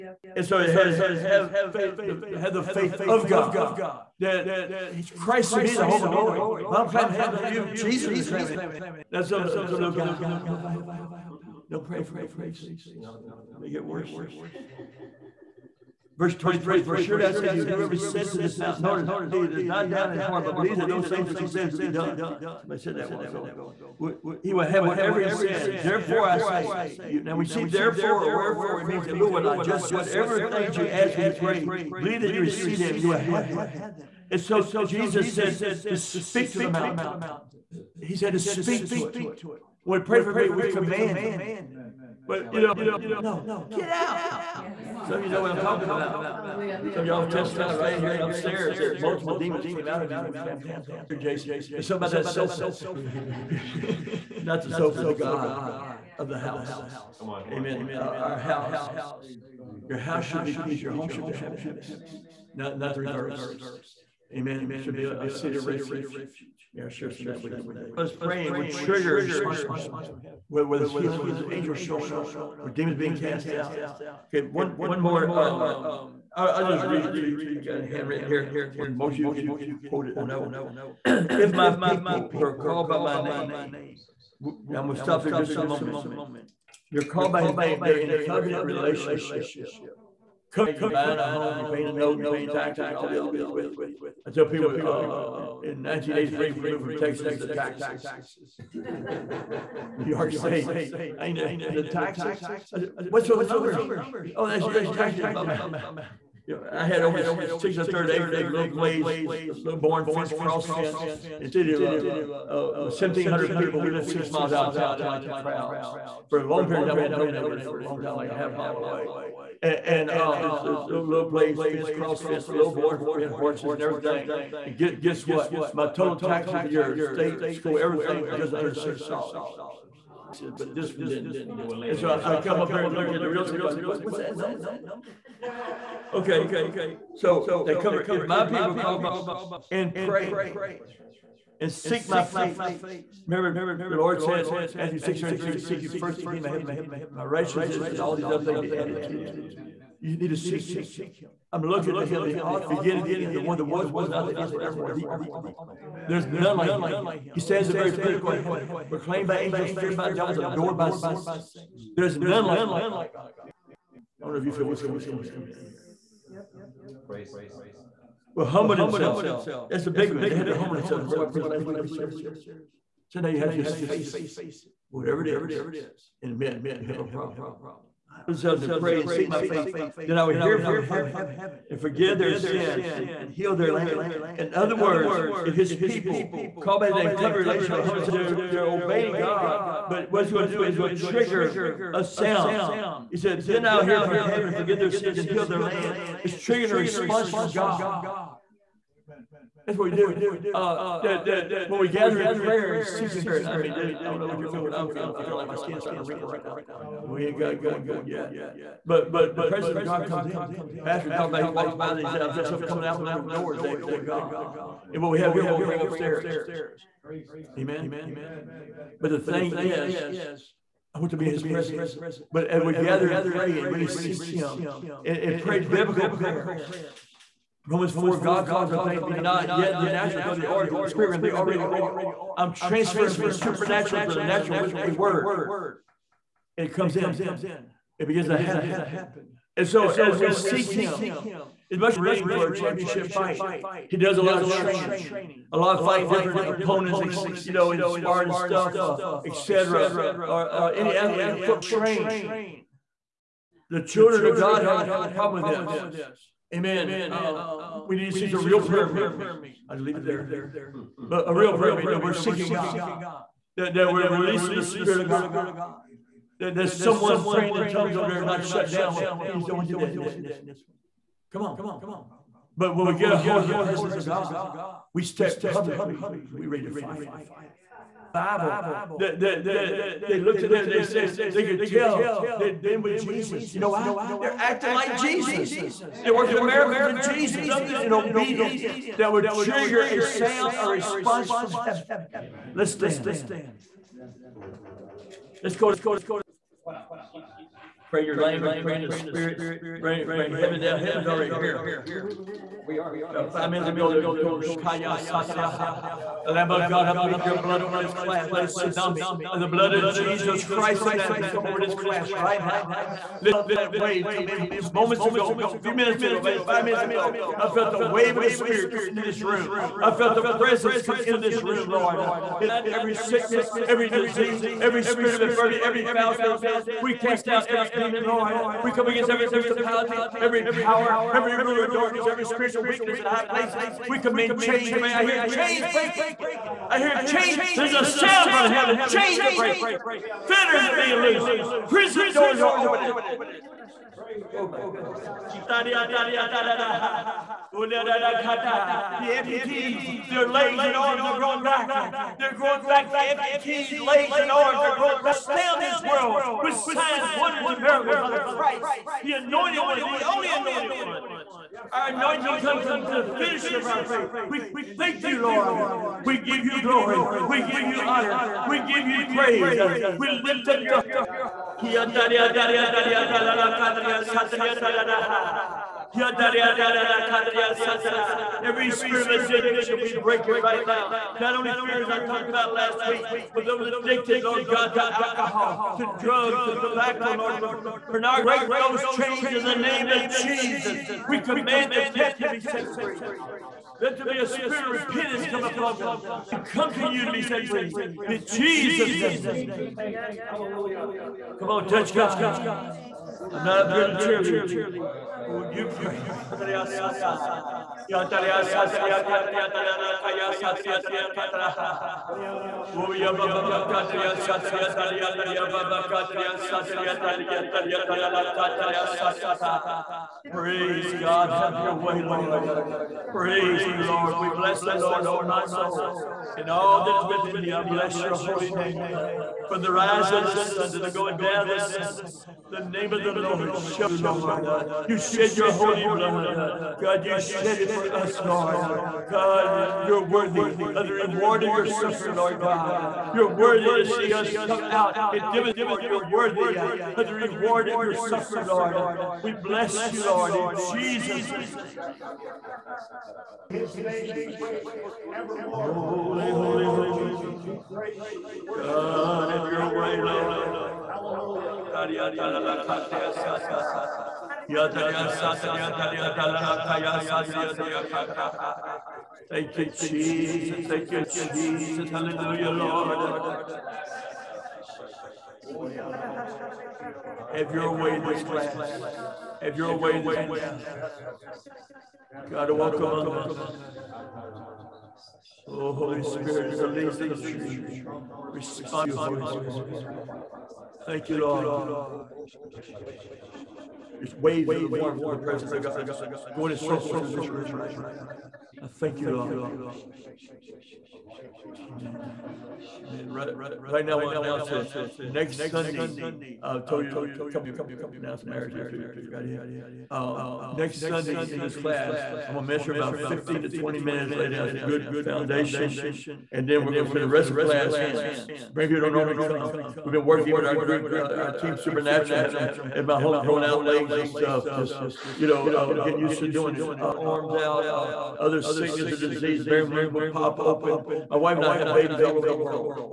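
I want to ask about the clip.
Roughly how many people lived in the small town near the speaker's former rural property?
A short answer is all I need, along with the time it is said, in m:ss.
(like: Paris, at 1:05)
1,700, at 1:52.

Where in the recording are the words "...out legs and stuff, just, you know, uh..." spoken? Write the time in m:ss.
8:43.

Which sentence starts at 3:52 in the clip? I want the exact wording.
I'm transferring from the supernatural to the natural with a word.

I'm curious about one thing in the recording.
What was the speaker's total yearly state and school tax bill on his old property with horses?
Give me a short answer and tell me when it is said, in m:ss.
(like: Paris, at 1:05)
just under 6 dollars, at 2:08.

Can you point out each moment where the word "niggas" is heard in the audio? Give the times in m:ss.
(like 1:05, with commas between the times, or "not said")
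not said.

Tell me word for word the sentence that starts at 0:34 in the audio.
And so Jesus said to speak to the mountain.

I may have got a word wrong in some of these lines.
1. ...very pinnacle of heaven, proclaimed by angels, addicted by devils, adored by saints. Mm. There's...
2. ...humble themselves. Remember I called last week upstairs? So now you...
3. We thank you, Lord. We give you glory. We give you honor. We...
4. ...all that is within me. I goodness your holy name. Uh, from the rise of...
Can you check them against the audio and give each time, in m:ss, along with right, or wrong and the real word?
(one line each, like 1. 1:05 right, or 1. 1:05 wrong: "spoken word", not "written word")
1. 2:37 wrong: "feared", not "addicted"
2. 2:50 wrong: "preached", not "called"
3. 6:04 right
4. 7:06 wrong: "bless", not "goodness".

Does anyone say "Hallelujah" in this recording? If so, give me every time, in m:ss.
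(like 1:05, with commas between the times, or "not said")
0:46, 6:40, 7:40, 7:51.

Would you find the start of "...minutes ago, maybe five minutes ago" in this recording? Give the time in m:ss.
5:15.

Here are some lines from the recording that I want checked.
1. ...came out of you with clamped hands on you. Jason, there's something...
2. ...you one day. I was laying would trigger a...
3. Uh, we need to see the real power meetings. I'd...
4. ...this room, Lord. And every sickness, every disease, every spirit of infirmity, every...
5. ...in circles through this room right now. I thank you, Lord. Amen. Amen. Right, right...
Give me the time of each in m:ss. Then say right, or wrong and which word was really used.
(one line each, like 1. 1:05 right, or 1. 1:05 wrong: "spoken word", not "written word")
1. 0:49 right
2. 1:07 wrong: "praying", not "laying"
3. 4:17 wrong: "prayer", not "power"
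4. 5:21 right
5. 8:16 right.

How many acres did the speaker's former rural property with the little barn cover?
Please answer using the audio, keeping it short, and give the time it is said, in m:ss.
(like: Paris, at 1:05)
6 and a third acres, at 1:47.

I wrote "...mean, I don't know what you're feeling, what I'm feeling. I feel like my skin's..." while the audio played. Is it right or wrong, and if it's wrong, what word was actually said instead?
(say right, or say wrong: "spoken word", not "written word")
right.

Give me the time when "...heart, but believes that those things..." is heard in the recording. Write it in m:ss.
0:20.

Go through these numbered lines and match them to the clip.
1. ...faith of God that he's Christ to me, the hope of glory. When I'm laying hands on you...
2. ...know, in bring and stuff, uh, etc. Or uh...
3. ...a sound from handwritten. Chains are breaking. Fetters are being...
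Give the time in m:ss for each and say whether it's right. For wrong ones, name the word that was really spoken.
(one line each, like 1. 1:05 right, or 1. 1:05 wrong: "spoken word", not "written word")
1. 0:02 right
2. 4:07 wrong: "sparring", not "bring"
3. 5:37 wrong: "heaven", not "handwritten".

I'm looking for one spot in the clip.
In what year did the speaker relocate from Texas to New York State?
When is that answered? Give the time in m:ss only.
1:35.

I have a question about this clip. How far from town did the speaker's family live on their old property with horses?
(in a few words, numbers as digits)
6 miles.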